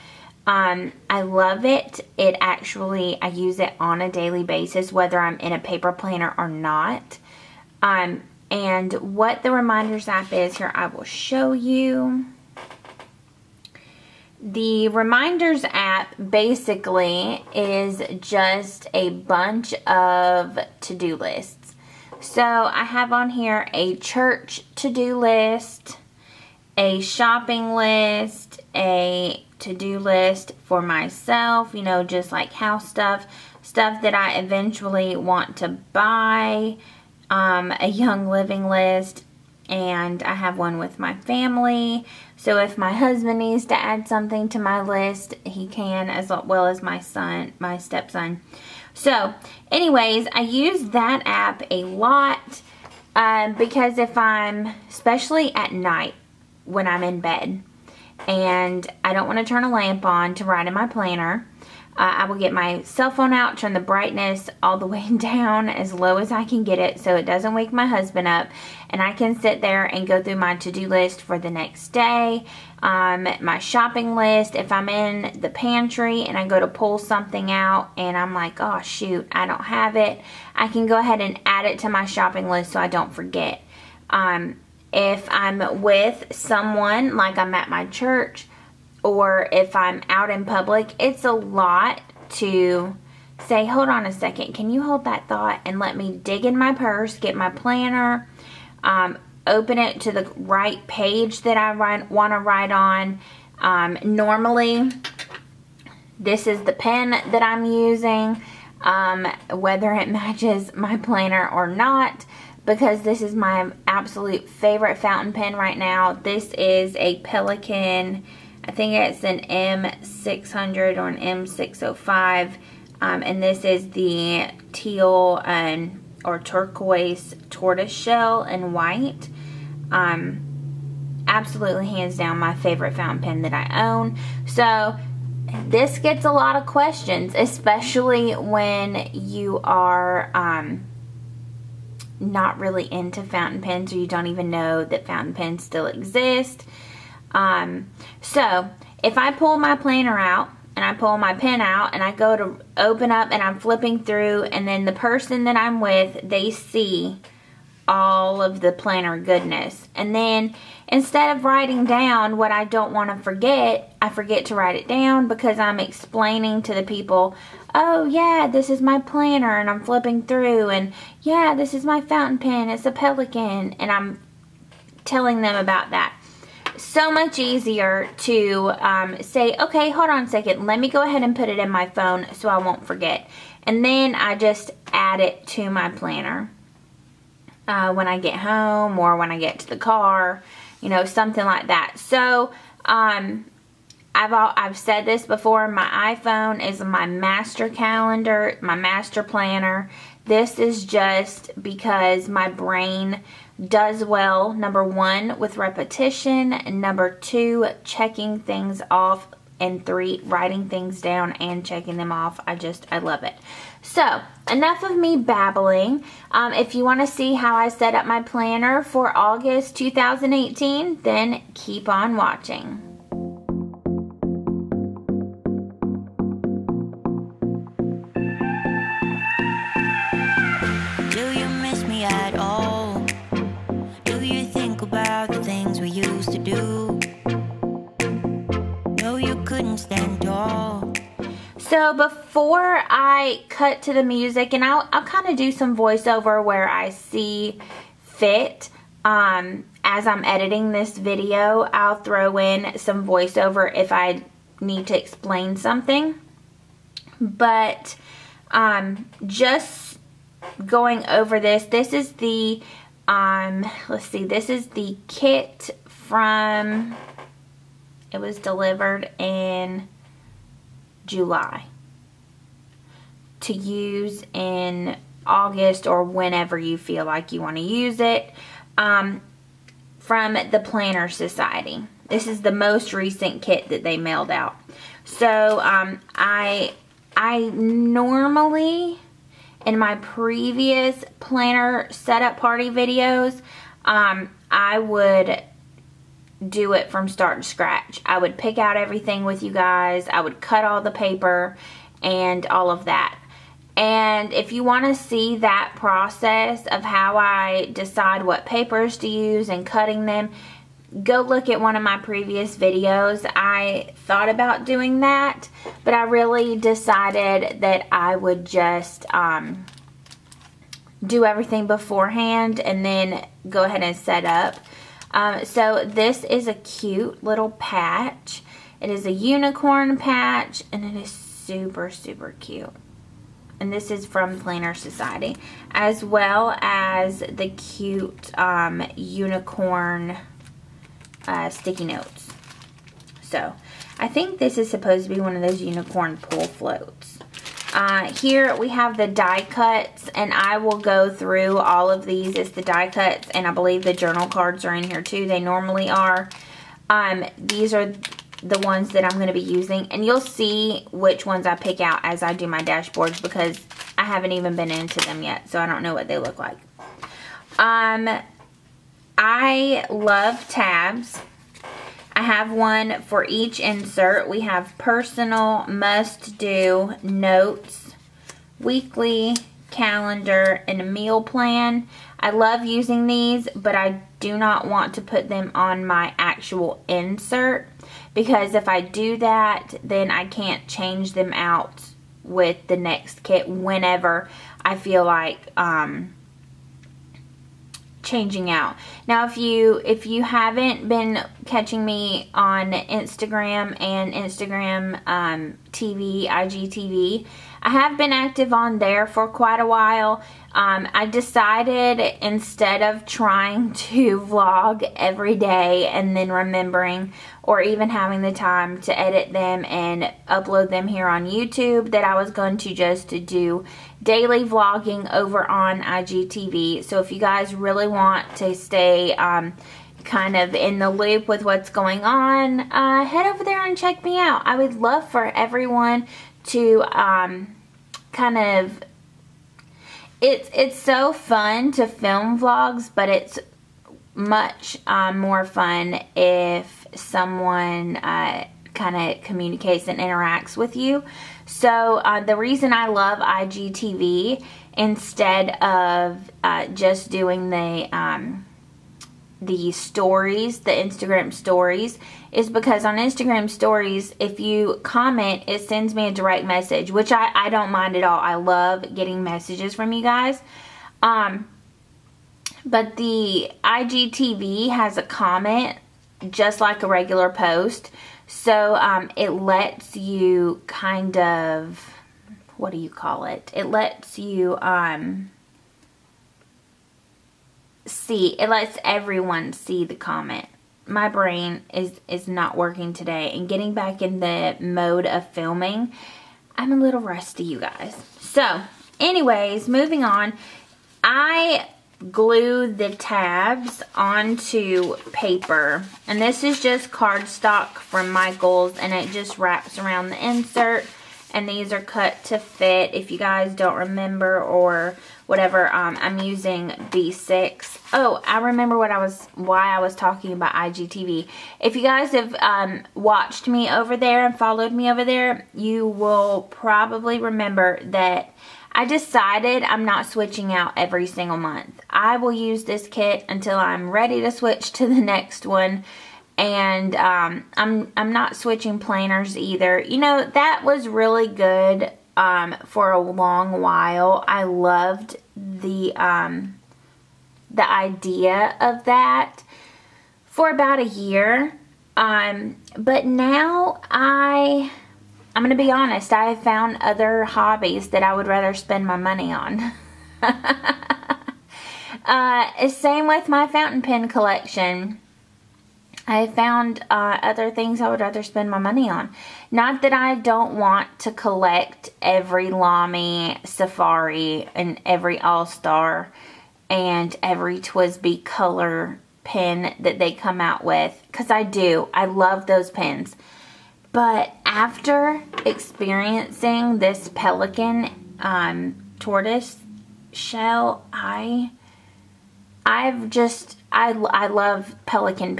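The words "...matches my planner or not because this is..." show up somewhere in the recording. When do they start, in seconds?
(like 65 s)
110 s.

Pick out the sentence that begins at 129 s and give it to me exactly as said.
Um, absolutely hands down my favorite fountain pen that I own.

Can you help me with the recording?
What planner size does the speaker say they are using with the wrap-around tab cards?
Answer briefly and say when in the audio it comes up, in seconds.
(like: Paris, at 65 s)
B6, at 516 s.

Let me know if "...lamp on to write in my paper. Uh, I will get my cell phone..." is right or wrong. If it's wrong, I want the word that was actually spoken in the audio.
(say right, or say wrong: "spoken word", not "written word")
wrong: "planner", not "paper".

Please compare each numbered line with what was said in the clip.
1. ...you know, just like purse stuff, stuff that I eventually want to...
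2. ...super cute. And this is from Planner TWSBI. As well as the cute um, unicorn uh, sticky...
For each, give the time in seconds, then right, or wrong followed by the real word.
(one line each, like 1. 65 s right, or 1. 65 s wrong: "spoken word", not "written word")
1. 31 s wrong: "house", not "purse"
2. 331 s wrong: "Society", not "TWSBI".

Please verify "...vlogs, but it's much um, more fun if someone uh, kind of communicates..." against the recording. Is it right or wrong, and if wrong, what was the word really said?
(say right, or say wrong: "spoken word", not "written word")
right.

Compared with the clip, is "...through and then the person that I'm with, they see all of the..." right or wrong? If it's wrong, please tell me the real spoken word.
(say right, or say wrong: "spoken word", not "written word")
right.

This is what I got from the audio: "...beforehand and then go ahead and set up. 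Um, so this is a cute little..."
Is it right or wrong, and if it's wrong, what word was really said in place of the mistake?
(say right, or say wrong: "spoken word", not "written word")
right.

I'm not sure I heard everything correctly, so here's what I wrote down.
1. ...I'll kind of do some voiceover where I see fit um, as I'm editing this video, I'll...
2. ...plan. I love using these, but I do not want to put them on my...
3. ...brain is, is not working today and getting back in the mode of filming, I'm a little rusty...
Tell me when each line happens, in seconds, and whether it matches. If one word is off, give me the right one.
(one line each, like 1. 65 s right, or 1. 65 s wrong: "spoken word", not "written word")
1. 244 s right
2. 381 s right
3. 491 s right.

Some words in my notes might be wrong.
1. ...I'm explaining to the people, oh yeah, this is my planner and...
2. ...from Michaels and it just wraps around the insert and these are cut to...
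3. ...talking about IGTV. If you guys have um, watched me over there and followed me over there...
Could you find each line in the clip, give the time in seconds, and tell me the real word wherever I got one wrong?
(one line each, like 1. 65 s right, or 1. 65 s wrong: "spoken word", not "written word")
1. 165 s right
2. 507 s right
3. 519 s right.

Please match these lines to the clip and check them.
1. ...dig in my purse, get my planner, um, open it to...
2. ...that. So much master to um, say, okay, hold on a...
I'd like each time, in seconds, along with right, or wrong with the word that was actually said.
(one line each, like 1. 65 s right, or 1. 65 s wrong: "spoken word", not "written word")
1. 96 s right
2. 175 s wrong: "easier", not "master".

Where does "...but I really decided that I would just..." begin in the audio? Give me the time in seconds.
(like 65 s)
315 s.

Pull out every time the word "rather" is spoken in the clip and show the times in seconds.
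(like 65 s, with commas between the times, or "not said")
558 s, 568 s.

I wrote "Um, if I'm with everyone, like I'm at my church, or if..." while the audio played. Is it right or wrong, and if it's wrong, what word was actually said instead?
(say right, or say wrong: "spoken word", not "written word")
wrong: "someone", not "everyone".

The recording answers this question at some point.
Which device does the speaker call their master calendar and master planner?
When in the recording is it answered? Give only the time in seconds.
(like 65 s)
196 s.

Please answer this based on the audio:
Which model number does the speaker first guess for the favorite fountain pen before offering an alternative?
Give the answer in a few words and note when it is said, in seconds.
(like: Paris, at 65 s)
M600, at 119 s.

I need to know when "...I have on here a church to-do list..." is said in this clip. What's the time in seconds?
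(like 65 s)
22 s.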